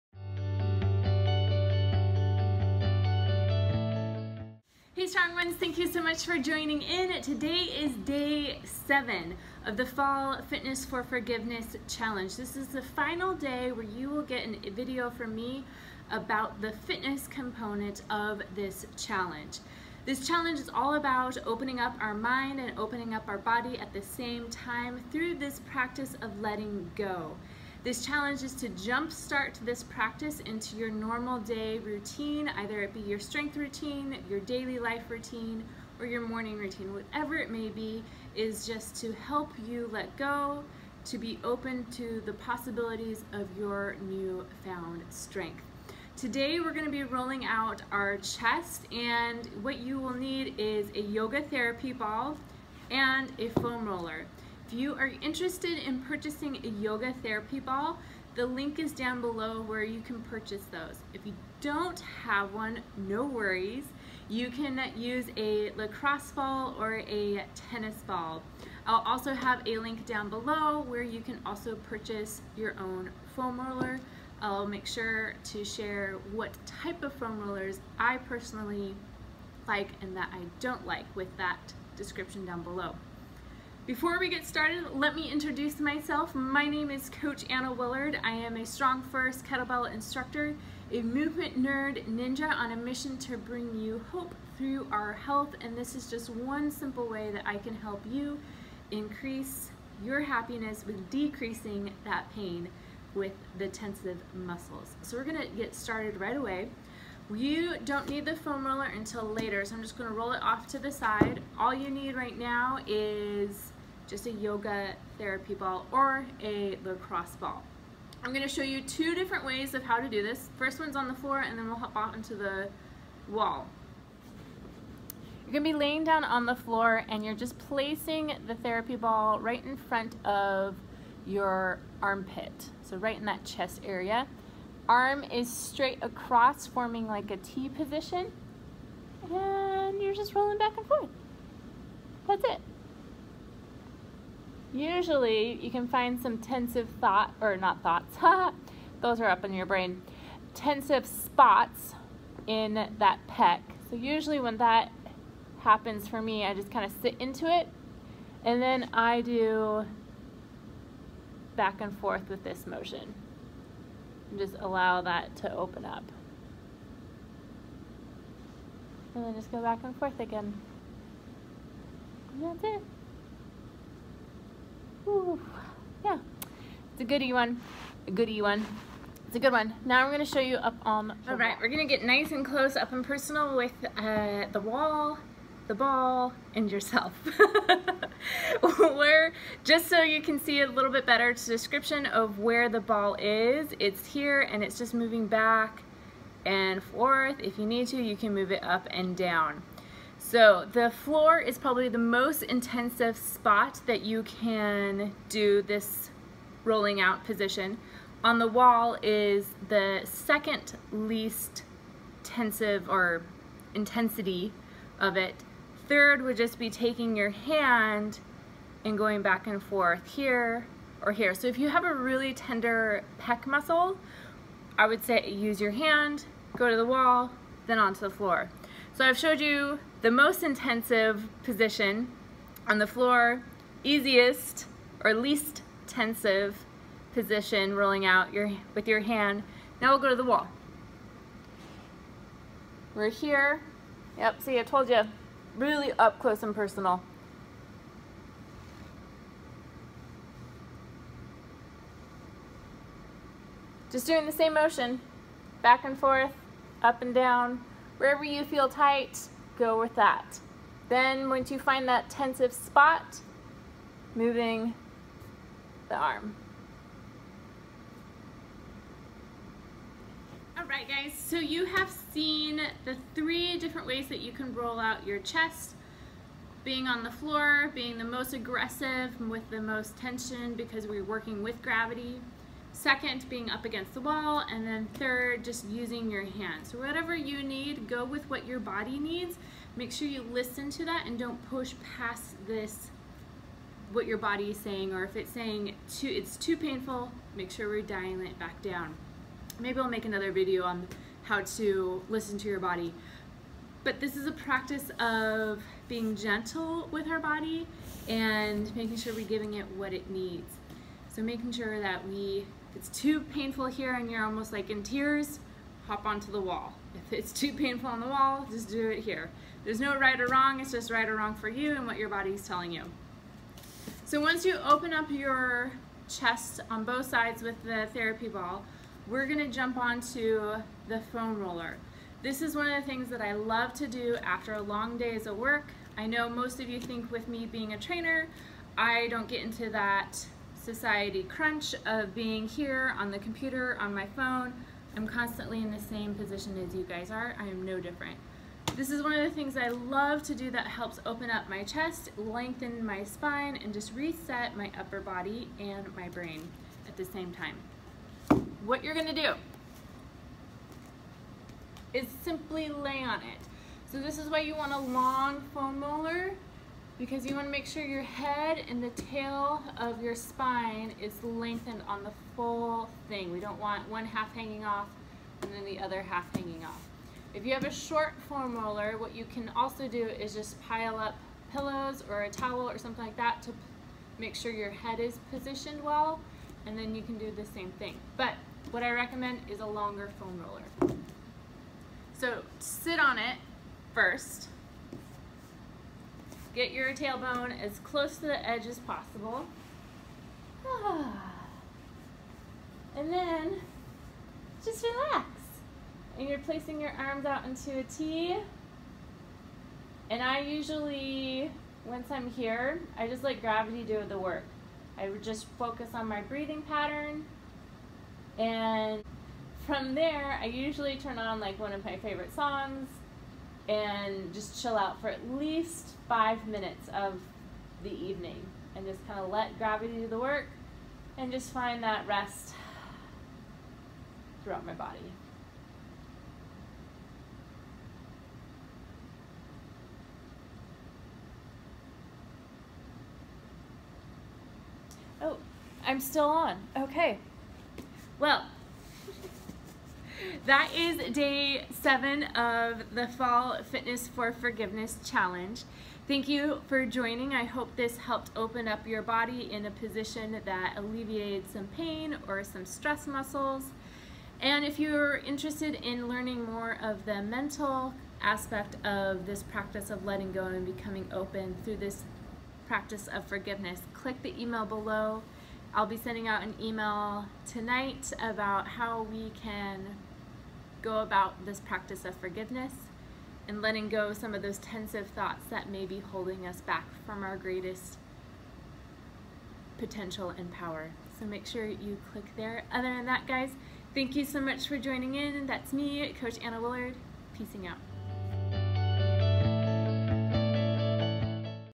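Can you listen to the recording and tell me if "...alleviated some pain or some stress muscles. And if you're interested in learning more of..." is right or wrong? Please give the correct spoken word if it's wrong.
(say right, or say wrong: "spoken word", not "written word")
right.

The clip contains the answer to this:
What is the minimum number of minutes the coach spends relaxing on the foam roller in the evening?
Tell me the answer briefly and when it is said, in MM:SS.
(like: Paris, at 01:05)
5, at 07:06.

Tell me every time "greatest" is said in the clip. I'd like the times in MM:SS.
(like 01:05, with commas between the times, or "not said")
08:07.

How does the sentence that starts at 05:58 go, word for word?
What you're gonna do is simply lay on it.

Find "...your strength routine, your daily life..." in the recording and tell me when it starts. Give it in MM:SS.
00:32.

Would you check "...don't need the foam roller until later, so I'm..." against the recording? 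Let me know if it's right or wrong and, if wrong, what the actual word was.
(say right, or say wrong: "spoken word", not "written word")
right.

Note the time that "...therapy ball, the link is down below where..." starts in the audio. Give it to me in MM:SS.
00:57.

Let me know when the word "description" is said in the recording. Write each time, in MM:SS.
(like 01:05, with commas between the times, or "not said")
01:21, 03:11.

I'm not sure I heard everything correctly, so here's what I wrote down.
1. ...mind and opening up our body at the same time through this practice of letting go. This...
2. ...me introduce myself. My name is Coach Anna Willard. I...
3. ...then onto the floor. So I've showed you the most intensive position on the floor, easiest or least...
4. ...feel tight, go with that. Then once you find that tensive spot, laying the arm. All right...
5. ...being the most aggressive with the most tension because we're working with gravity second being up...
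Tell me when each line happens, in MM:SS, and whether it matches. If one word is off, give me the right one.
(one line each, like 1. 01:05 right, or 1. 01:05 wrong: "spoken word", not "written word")
1. 00:22 right
2. 01:25 right
3. 03:47 right
4. 04:18 wrong: "moving", not "laying"
5. 04:37 right.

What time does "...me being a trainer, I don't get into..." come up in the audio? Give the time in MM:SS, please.
05:37.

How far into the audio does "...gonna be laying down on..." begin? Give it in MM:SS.
02:05.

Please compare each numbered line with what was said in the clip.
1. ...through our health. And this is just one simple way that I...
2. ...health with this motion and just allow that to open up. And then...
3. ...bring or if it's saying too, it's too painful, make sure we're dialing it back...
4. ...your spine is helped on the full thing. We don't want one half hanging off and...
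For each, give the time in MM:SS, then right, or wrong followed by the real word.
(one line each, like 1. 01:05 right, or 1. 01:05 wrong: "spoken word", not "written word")
1. 01:34 right
2. 02:41 wrong: "forth", not "health"
3. 04:54 wrong: "saying", not "bring"
4. 06:10 wrong: "lengthened", not "helped".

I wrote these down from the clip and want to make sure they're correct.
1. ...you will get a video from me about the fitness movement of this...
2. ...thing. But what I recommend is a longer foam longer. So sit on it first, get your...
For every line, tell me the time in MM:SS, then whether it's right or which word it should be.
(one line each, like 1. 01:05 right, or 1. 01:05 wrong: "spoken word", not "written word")
1. 00:13 wrong: "component", not "movement"
2. 06:27 wrong: "roller", not "longer".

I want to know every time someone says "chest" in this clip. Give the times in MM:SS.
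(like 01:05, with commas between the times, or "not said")
00:48, 02:13, 04:35, 05:26, 05:51.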